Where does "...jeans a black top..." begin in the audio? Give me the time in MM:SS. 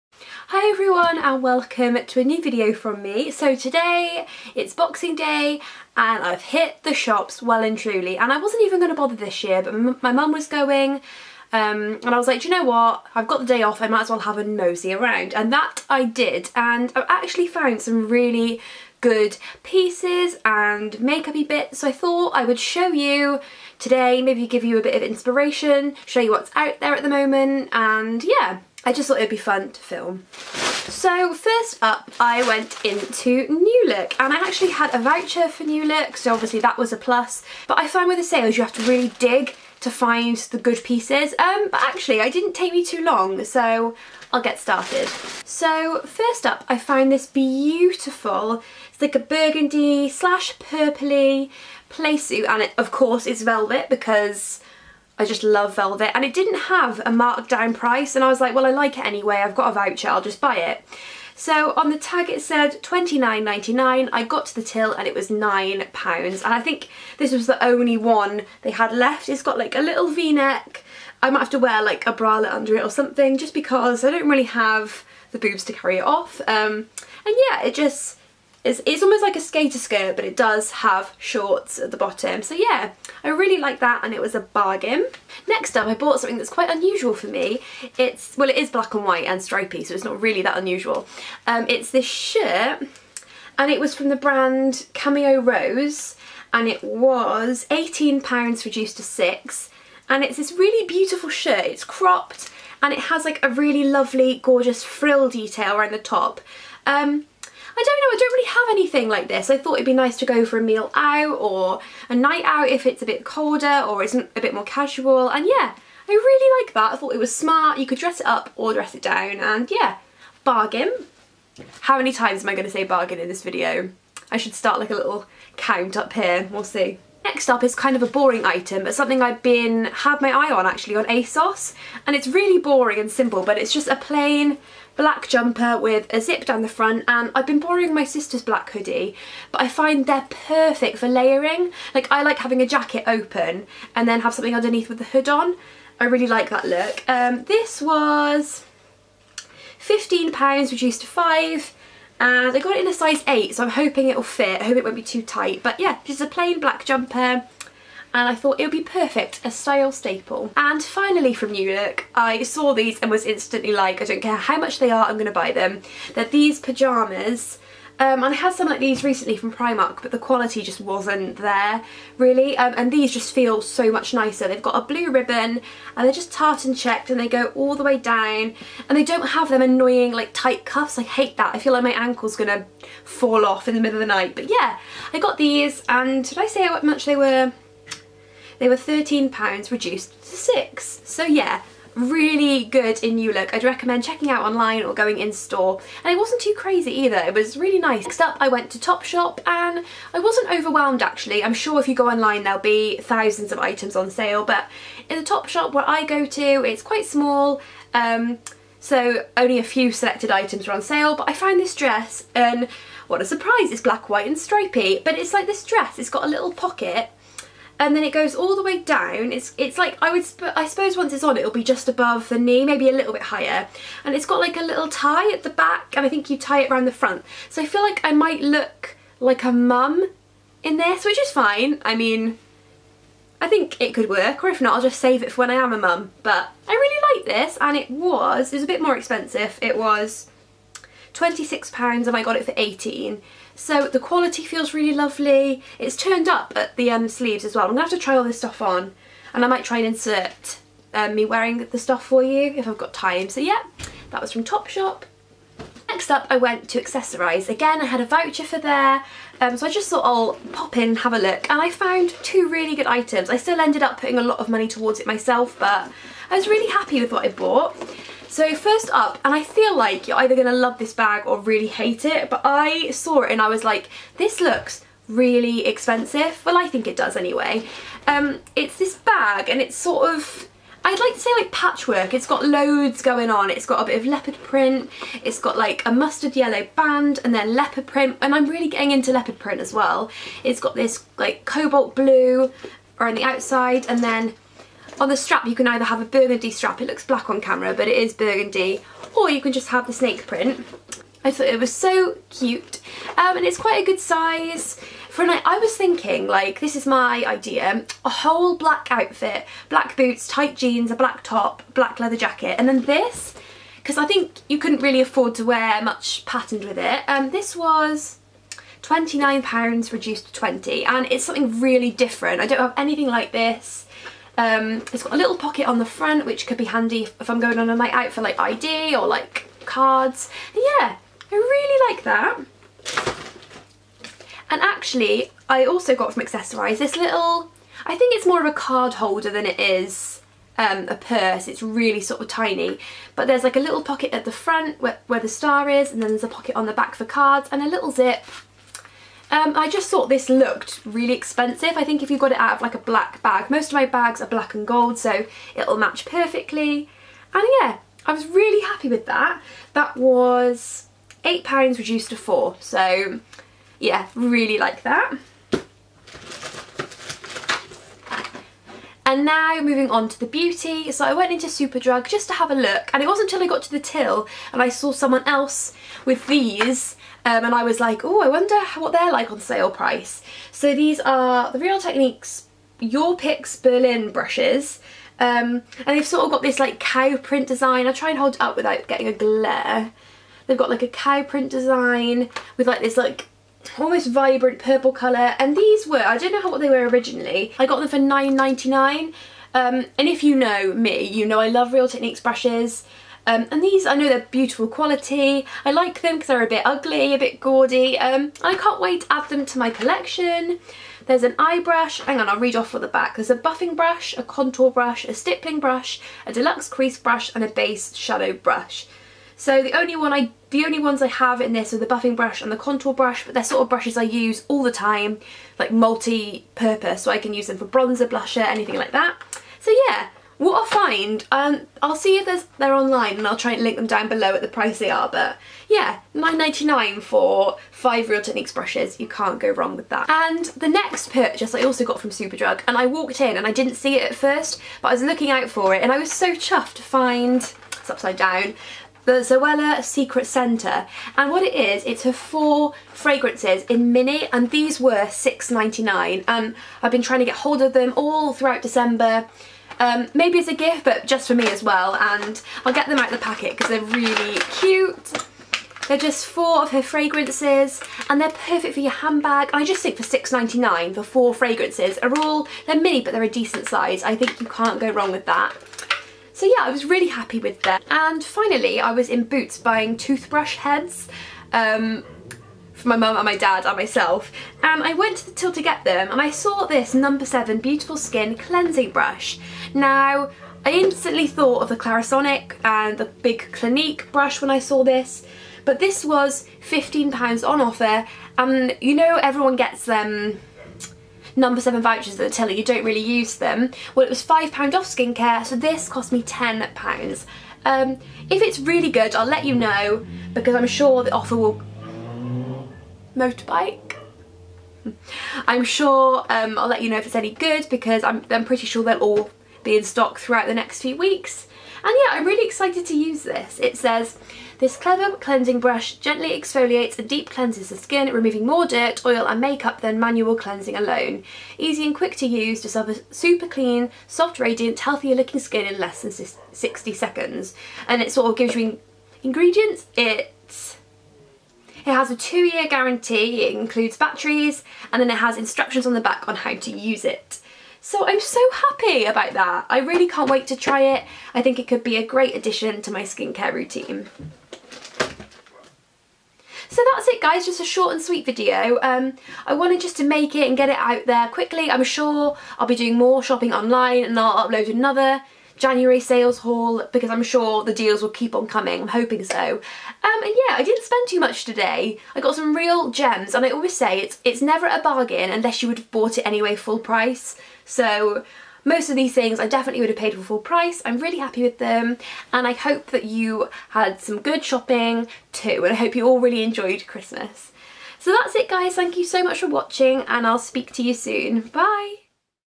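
05:10.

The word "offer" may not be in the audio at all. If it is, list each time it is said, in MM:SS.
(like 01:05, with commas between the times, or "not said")
08:17, 08:31.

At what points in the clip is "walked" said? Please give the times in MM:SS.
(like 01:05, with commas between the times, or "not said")
07:22.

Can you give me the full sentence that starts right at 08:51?
Easy and quick to use to a super clean, soft, radiant, healthier looking skin in less than 60 seconds.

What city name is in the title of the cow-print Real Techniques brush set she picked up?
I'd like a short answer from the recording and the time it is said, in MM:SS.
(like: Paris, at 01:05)
Berlin, at 06:23.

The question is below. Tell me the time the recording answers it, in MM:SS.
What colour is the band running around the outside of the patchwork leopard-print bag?
04:51.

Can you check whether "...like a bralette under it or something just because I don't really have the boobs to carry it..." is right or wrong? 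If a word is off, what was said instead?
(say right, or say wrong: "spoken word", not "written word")
right.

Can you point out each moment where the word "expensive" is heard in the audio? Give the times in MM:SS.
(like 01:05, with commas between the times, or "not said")
03:58, 04:35, 05:51.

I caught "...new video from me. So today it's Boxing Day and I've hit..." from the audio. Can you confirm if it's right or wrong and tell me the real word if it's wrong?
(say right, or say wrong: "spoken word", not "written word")
right.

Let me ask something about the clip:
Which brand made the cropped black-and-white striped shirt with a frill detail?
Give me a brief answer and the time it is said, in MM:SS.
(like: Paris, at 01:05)
Cameo Rose, at 01:34.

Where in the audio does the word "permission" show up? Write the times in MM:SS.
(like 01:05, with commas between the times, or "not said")
not said.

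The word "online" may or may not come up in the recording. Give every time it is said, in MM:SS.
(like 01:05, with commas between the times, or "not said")
03:14, 03:22, 07:12, 09:23.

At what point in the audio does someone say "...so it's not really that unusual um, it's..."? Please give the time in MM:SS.
01:29.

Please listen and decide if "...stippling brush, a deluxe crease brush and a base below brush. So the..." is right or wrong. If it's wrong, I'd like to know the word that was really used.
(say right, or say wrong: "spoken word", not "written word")
wrong: "shadow", not "below".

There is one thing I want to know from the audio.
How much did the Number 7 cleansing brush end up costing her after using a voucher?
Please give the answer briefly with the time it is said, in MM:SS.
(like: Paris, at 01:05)
£10, at 08:26.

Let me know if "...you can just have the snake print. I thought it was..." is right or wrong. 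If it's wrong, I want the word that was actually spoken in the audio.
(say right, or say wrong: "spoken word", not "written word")
right.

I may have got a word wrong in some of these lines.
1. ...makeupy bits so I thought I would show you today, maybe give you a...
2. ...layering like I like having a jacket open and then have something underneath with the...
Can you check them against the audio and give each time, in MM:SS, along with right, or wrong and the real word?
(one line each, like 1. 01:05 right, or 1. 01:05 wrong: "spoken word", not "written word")
1. 00:20 right
2. 02:21 right.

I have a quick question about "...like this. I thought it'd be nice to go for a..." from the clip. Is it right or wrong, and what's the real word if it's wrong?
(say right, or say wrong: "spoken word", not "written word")
right.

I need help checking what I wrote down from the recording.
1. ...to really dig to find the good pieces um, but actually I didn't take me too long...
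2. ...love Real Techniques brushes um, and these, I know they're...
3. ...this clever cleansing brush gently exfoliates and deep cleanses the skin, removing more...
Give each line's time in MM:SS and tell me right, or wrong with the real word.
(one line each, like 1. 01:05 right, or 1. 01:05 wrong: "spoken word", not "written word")
1. 00:38 right
2. 06:41 right
3. 08:44 right.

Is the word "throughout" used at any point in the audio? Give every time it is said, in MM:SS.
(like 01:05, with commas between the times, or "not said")
07:38, 08:40.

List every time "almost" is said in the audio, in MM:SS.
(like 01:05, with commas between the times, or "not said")
01:19, 06:33.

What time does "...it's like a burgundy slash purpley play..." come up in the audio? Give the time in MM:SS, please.
00:48.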